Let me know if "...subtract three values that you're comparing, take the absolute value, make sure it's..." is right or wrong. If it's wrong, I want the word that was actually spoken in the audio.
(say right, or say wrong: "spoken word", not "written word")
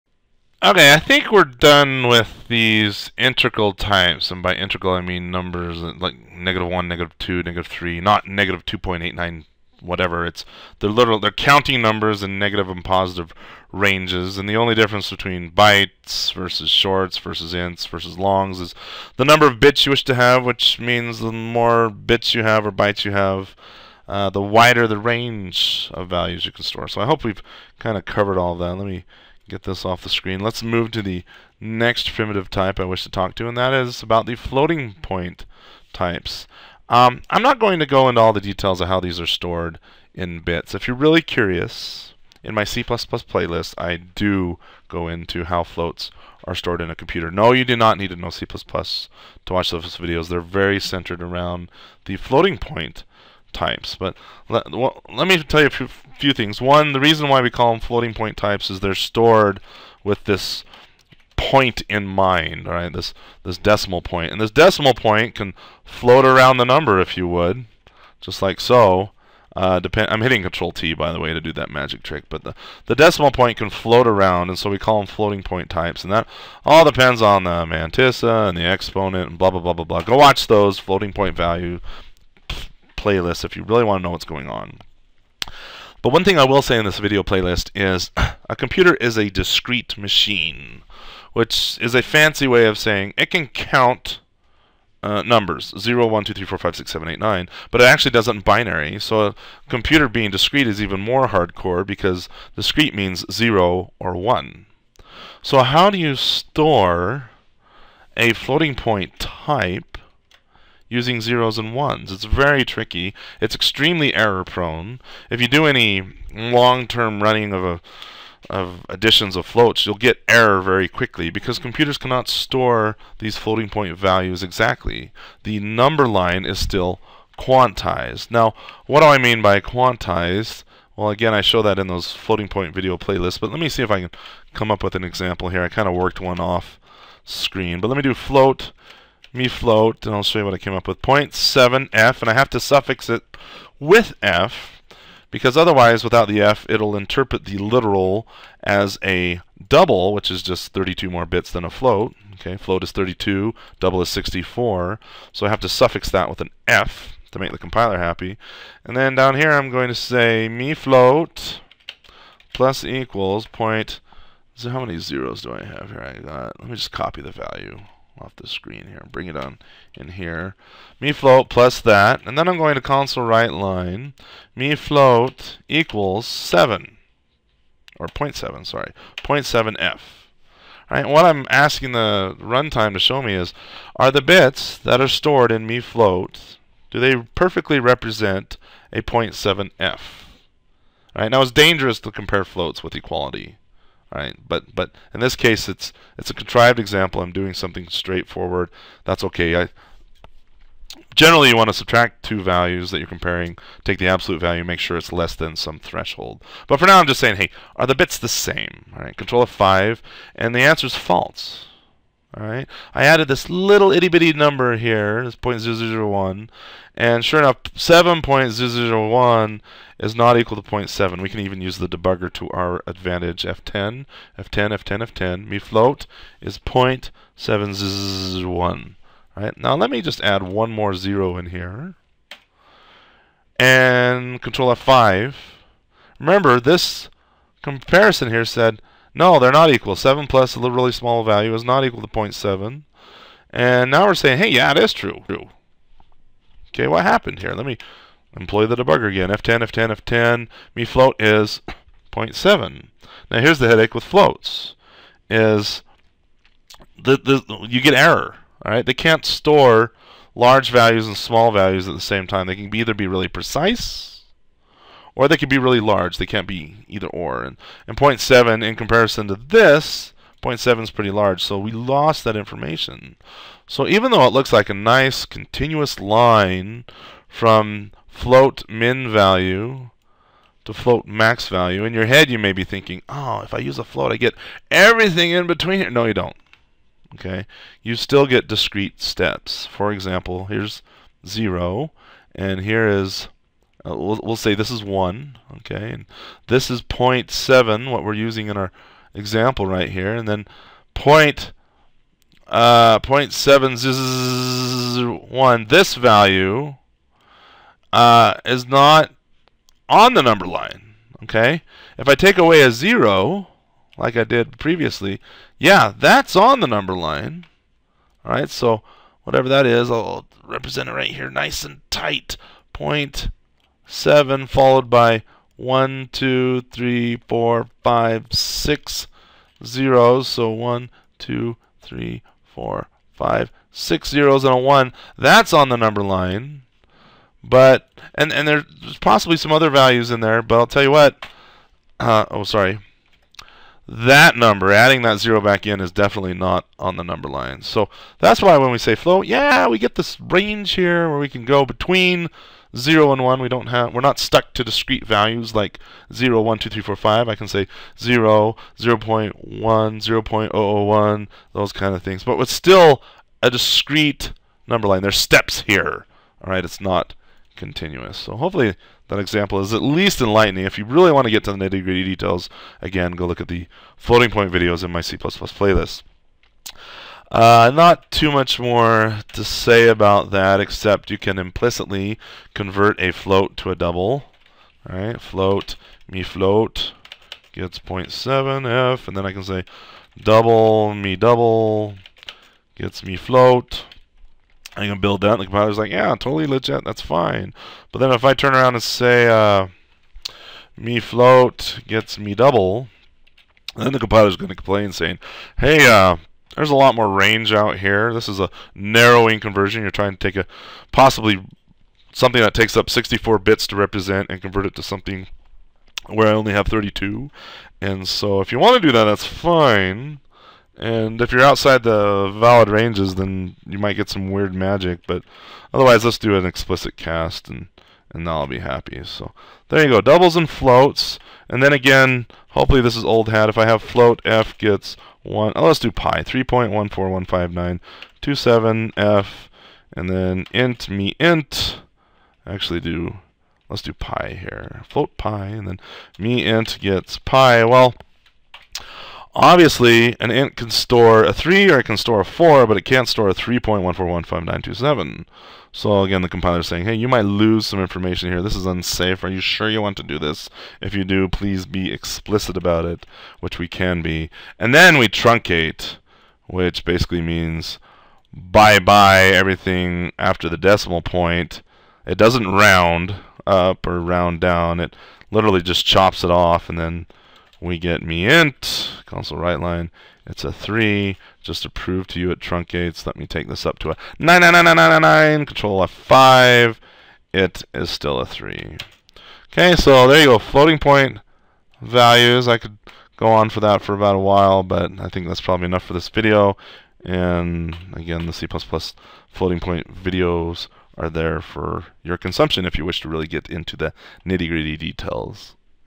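wrong: "two", not "three".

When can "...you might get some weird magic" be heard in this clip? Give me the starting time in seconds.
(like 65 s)
423 s.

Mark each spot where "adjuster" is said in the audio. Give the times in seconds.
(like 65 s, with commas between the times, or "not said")
not said.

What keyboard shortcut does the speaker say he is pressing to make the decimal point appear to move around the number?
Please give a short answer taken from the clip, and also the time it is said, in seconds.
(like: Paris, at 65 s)
Control T, at 70 s.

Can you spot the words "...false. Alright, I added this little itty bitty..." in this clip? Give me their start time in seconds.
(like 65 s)
210 s.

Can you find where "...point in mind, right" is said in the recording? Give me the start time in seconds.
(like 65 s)
61 s.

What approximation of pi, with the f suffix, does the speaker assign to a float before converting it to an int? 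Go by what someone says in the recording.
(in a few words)
3.1415927.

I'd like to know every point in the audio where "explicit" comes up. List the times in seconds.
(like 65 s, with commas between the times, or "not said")
426 s, 461 s.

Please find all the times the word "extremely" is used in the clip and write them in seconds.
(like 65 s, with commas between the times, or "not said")
113 s.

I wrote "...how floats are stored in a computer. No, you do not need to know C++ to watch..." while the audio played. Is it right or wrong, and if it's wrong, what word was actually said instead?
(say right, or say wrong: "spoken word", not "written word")
right.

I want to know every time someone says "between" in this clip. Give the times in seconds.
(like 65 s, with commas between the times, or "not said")
15 s, 285 s, 351 s.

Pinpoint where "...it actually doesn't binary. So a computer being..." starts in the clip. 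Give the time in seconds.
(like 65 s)
97 s.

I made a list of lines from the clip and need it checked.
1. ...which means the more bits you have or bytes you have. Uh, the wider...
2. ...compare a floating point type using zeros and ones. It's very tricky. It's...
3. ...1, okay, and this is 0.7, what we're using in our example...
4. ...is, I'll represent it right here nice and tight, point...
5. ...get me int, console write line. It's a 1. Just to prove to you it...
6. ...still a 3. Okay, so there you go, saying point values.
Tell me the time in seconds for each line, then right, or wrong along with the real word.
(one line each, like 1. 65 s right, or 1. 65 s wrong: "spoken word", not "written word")
1. 20 s right
2. 106 s wrong: "store", not "compare"
3. 294 s right
4. 319 s right
5. 477 s wrong: "3", not "1"
6. 487 s wrong: "floating", not "saying".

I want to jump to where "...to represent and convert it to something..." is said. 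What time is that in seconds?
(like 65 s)
413 s.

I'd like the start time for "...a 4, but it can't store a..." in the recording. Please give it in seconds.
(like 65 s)
452 s.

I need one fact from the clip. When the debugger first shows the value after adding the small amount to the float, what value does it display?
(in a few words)
0.701.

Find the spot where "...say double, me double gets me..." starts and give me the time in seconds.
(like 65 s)
389 s.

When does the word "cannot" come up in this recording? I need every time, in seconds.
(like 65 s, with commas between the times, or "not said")
121 s.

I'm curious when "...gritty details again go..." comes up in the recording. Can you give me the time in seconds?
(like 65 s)
371 s.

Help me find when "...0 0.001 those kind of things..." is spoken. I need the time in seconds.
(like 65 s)
360 s.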